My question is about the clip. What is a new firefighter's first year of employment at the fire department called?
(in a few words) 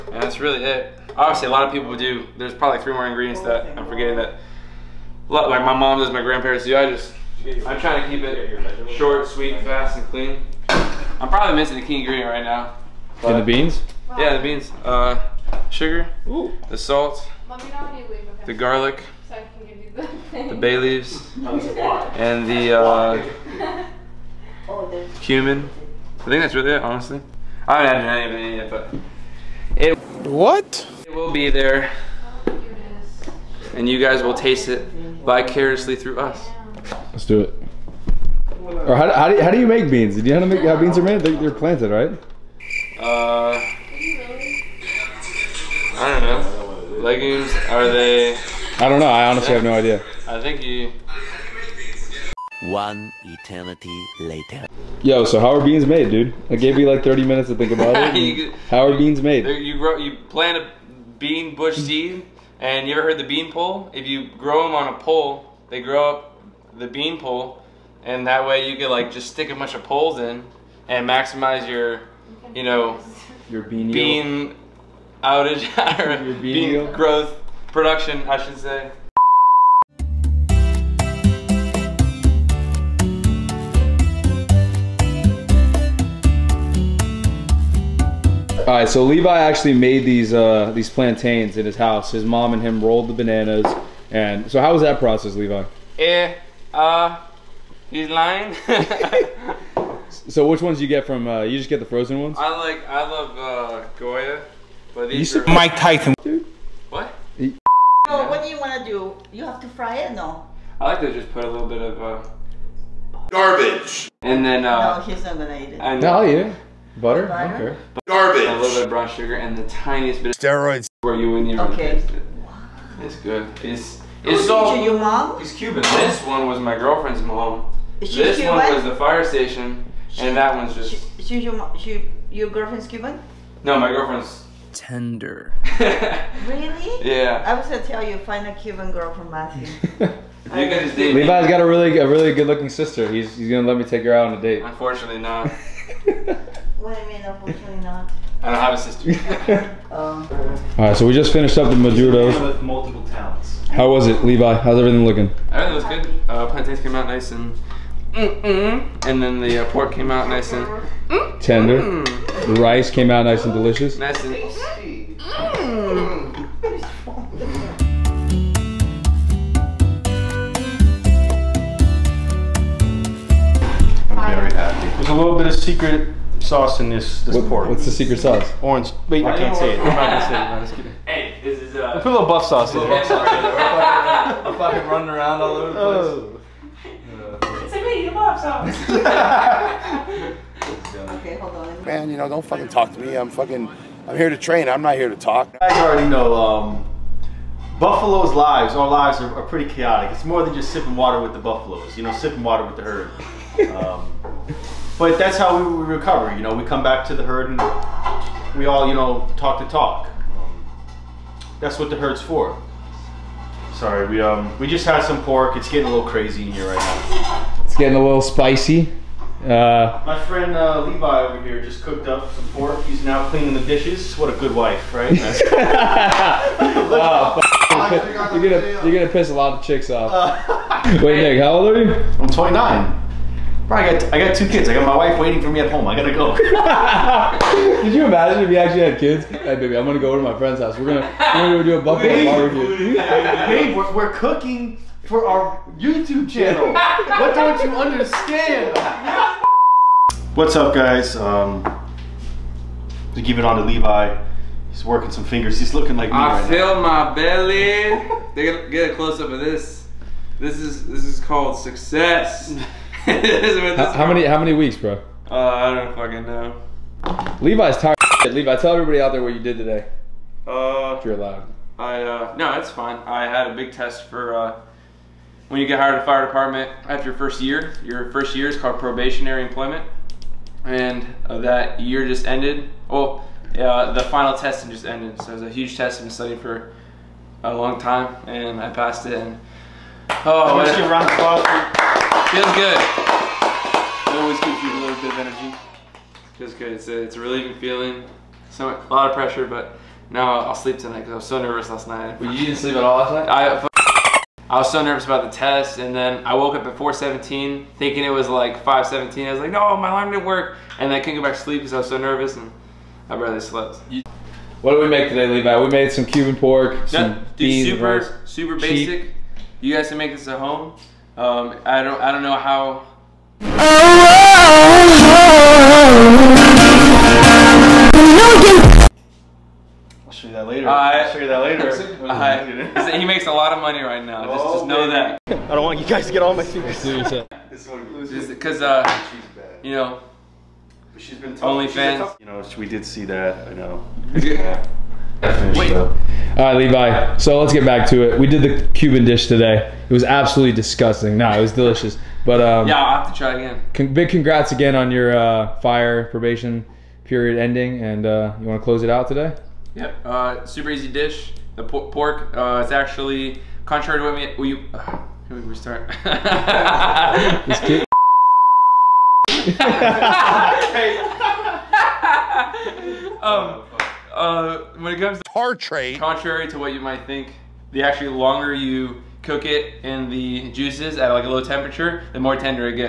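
probationary employment.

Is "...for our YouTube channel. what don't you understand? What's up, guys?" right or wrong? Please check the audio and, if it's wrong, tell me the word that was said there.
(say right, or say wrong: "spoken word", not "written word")
right.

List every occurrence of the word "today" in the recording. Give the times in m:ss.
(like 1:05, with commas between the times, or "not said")
4:29, 5:15, 5:49, 5:59.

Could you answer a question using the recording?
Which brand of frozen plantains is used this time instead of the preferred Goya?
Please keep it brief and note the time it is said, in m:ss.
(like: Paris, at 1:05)
Mike Tyson, at 1:45.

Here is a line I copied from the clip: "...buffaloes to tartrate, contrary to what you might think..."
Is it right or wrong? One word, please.
wrong.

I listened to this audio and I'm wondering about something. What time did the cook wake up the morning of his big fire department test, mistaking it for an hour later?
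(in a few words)
4:17.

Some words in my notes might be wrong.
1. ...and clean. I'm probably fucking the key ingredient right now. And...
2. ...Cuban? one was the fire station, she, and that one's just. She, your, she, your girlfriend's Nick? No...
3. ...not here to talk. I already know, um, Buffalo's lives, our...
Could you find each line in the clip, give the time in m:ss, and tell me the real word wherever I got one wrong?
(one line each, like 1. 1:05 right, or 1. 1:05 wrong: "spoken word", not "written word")
1. 0:09 wrong: "missing", not "fucking"
2. 2:08 wrong: "Cuban", not "Nick"
3. 3:14 right.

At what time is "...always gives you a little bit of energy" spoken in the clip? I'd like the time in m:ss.
4:54.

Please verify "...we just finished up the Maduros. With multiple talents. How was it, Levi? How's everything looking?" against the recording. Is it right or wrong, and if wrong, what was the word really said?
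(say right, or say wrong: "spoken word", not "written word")
right.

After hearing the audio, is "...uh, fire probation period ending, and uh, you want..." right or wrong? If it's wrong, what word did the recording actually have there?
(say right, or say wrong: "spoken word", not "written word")
right.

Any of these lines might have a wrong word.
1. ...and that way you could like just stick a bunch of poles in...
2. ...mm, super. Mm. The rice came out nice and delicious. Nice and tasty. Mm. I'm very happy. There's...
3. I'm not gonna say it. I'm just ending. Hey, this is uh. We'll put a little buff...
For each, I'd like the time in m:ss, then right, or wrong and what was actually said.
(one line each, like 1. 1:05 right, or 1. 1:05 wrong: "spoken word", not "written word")
1. 1:08 right
2. 2:41 wrong: "tender", not "super"
3. 2:59 wrong: "kidding", not "ending".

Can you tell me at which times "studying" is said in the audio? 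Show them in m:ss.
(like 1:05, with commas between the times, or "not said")
4:46.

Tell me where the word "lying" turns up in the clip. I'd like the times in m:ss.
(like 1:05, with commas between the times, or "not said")
1:38.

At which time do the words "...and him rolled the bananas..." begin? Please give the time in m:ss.
1:32.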